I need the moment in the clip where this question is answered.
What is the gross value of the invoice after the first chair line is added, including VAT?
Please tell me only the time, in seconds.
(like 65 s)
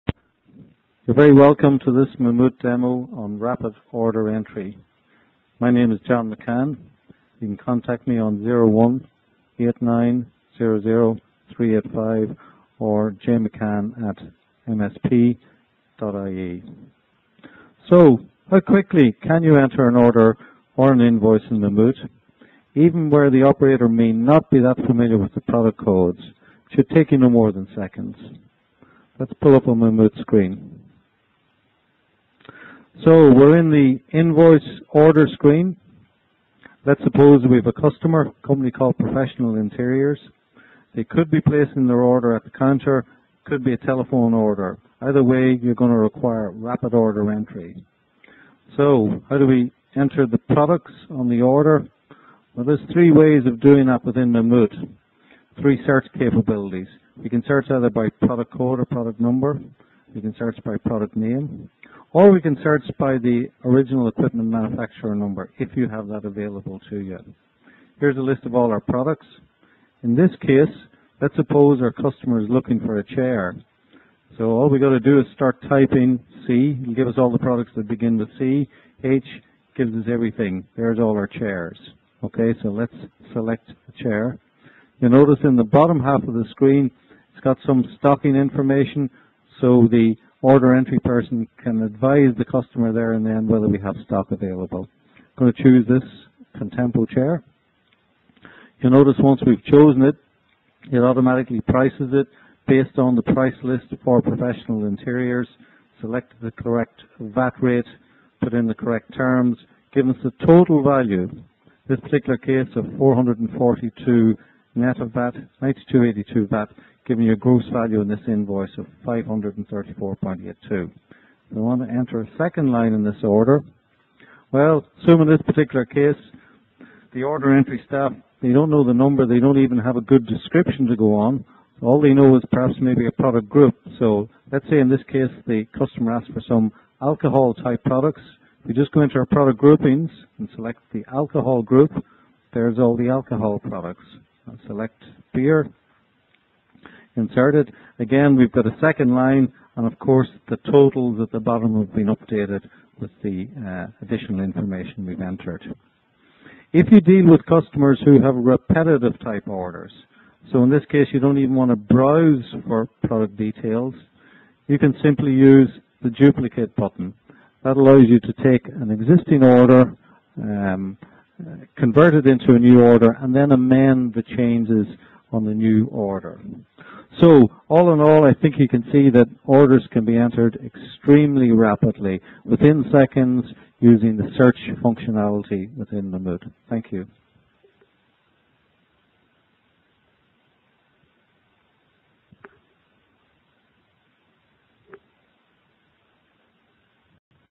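119 s.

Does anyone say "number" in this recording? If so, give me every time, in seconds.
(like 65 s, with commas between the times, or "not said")
59 s, 65 s, 128 s.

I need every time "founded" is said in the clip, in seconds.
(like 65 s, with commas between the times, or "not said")
not said.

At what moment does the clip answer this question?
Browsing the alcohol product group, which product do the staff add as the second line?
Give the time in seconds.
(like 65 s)
145 s.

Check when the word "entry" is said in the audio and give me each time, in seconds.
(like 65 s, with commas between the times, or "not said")
4 s, 47 s, 90 s, 127 s.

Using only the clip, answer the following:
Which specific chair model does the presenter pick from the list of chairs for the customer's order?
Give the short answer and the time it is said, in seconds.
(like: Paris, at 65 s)
Contempo, at 96 s.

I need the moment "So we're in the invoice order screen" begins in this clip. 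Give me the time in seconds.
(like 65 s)
33 s.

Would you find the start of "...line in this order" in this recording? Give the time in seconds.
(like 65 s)
122 s.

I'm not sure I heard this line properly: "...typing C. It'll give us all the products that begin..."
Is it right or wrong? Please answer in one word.
right.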